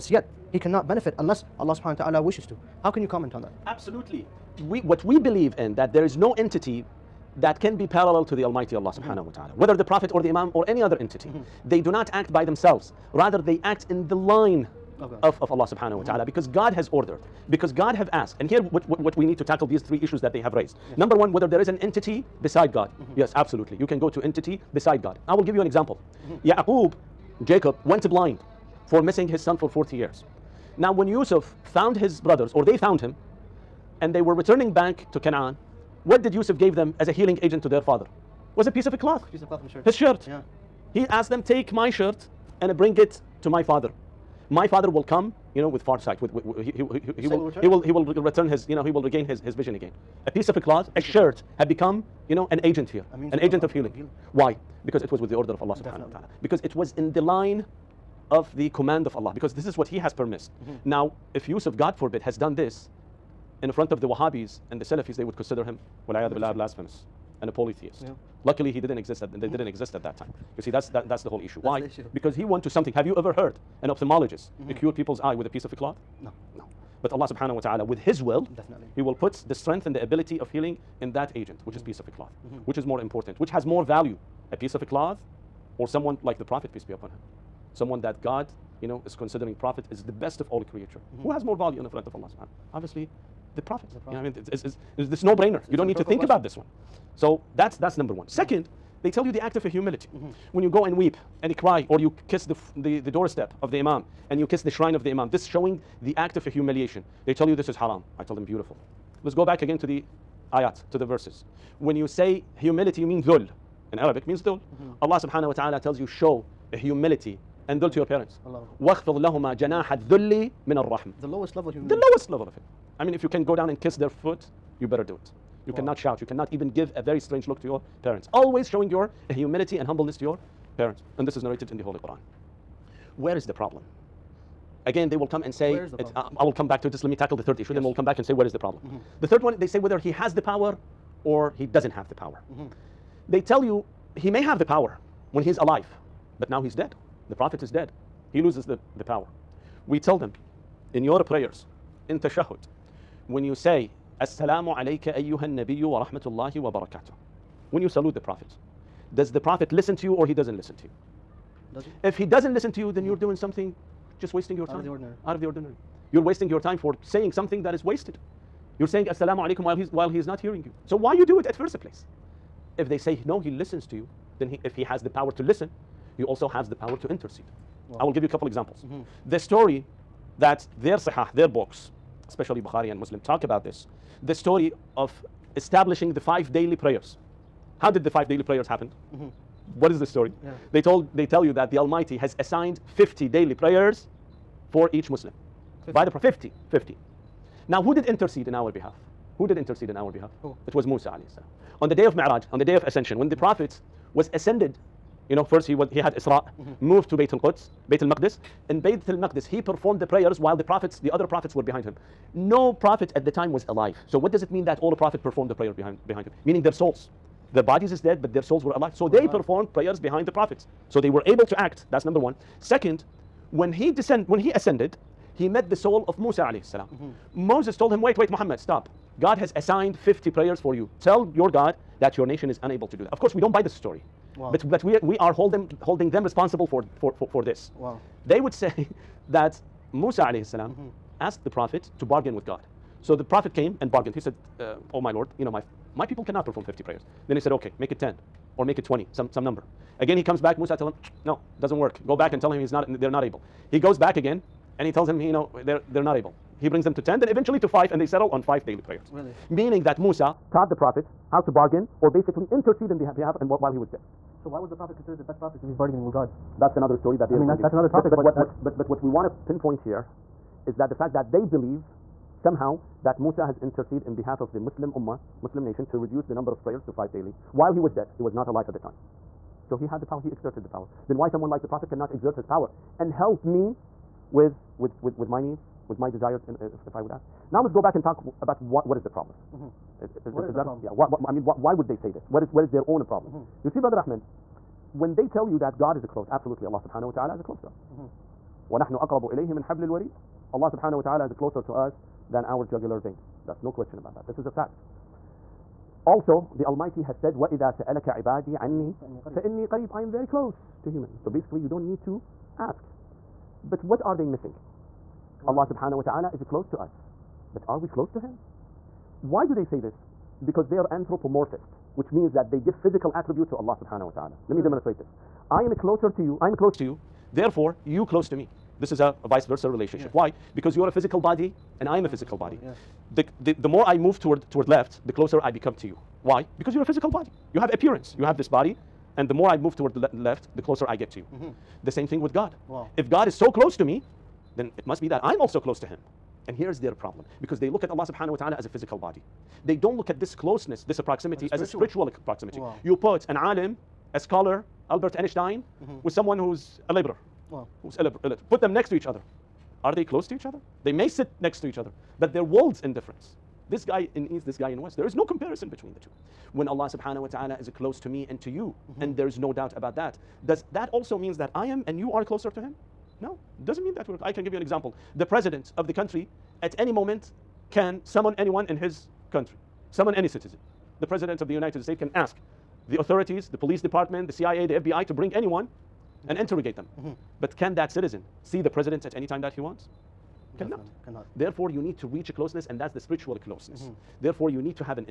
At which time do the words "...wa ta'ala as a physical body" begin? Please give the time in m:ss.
5:48.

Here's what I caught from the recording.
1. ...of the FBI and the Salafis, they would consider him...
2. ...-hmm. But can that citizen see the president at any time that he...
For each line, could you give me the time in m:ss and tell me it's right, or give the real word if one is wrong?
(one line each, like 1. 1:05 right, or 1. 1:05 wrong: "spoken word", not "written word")
1. 1:03 wrong: "Wahhabis", not "FBI"
2. 6:27 right.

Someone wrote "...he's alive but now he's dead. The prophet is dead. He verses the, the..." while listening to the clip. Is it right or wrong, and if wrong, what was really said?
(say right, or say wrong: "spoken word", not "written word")
wrong: "loses", not "verses".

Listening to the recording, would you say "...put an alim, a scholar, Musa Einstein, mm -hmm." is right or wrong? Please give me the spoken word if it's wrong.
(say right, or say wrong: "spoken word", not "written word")
wrong: "Albert", not "Musa".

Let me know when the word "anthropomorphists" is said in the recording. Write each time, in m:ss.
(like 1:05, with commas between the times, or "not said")
5:20.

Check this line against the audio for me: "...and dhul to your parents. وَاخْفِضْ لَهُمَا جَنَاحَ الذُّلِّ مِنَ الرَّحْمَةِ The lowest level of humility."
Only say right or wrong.
right.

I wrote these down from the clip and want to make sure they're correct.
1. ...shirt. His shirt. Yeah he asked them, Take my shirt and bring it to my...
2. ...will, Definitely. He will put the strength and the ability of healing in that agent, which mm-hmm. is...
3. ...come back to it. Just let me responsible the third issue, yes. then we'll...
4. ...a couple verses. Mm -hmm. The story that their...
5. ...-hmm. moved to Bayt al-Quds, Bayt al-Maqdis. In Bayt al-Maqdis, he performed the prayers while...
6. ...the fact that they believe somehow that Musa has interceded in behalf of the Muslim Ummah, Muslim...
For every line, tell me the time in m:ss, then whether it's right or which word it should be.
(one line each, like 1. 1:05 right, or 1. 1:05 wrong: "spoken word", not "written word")
1. 0:39 right
2. 1:18 right
3. 2:16 wrong: "tackle", not "responsible"
4. 2:58 wrong: "examples", not "verses"
5. 3:26 right
6. 4:30 right.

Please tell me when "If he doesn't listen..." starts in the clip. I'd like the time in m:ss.
2:42.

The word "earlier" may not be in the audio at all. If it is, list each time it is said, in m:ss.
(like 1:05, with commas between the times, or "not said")
not said.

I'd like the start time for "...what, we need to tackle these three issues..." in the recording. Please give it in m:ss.
0:18.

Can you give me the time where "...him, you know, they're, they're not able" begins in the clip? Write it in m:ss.
4:15.